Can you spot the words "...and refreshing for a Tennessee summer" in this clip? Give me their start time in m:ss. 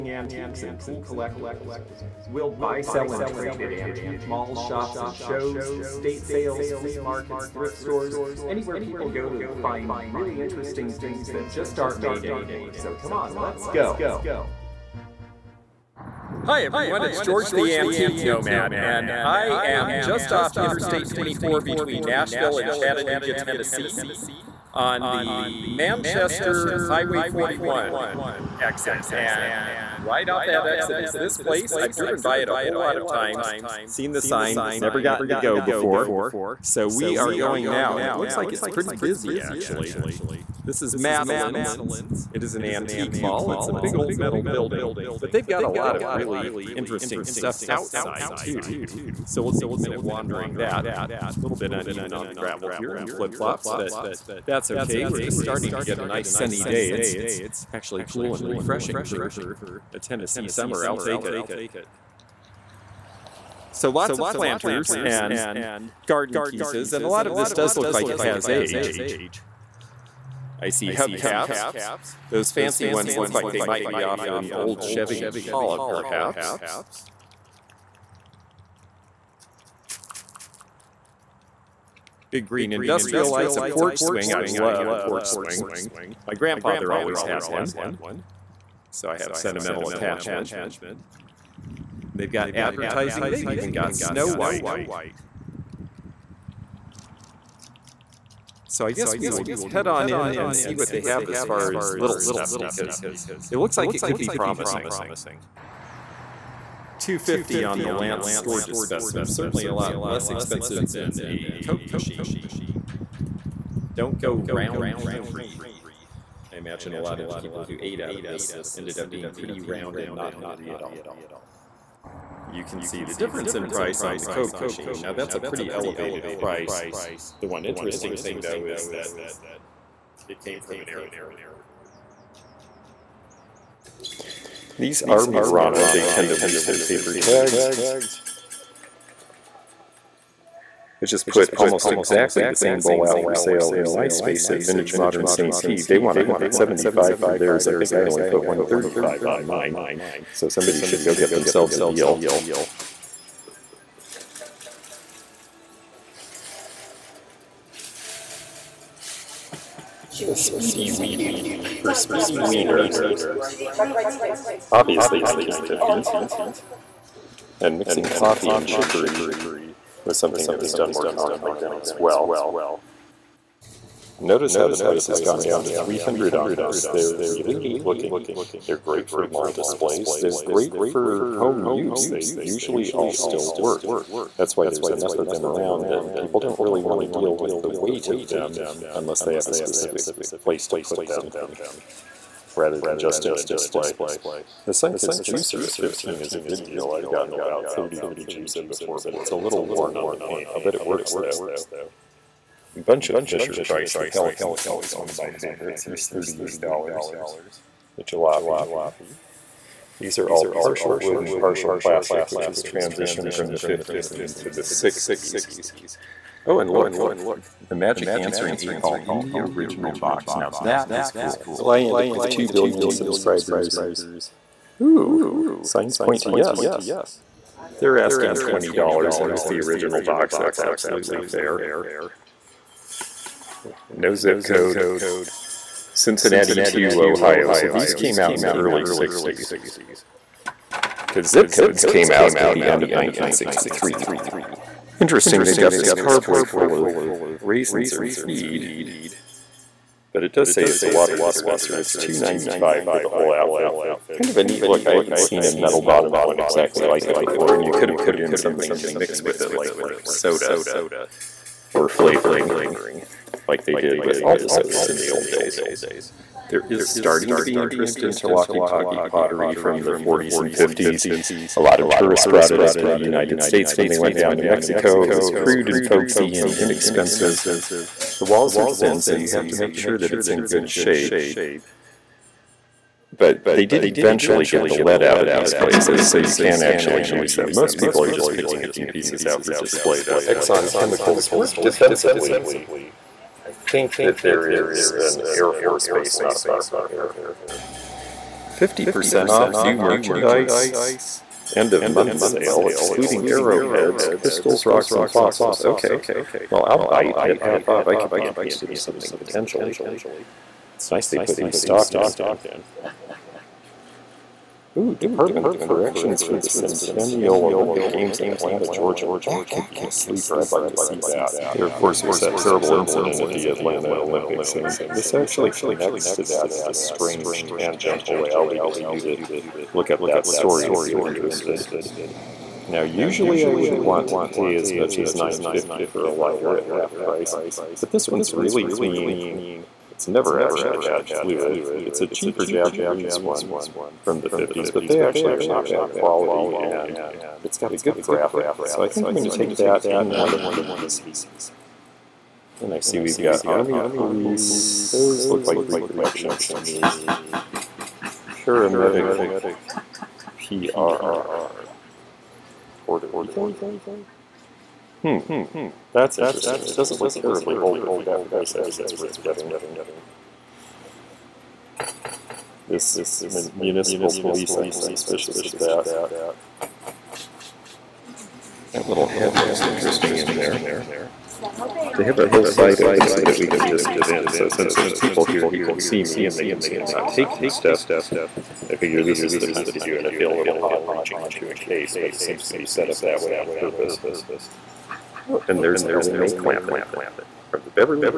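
0:58.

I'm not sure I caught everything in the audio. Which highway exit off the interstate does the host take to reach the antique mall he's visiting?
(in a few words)
Manchester Highway 41.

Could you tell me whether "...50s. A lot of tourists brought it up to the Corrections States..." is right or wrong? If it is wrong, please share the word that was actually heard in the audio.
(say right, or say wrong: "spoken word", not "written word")
wrong: "United", not "Corrections".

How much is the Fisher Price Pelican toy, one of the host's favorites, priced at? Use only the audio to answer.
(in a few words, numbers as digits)
$38.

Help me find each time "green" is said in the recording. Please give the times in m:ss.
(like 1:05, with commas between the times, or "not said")
1:22.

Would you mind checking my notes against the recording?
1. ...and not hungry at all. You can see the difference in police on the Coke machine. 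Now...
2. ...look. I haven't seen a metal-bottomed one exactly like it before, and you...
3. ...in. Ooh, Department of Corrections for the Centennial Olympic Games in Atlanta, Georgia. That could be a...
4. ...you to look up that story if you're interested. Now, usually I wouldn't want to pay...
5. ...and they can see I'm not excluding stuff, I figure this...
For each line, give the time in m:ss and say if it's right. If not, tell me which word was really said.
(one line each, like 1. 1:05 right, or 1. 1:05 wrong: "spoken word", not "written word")
1. 1:59 wrong: "price", not "police"
2. 4:14 right
3. 5:11 right
4. 5:28 right
5. 6:26 wrong: "taking", not "excluding".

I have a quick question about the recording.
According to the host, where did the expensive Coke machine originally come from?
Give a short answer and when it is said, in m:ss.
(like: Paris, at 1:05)
An airport, at 2:10.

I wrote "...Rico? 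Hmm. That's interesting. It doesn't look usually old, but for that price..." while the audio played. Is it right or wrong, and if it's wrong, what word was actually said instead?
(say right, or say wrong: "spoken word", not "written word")
wrong: "terribly", not "usually".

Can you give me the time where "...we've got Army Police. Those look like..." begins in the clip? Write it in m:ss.
5:53.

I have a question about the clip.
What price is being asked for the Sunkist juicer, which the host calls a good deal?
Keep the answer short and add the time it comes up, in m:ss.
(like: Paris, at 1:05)
15, at 3:15.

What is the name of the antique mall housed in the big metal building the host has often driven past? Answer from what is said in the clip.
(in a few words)
Madeline's.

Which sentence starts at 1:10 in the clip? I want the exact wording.
I see hubcaps, those fancy ones look like they might be off an old Chevy Impala, perhaps.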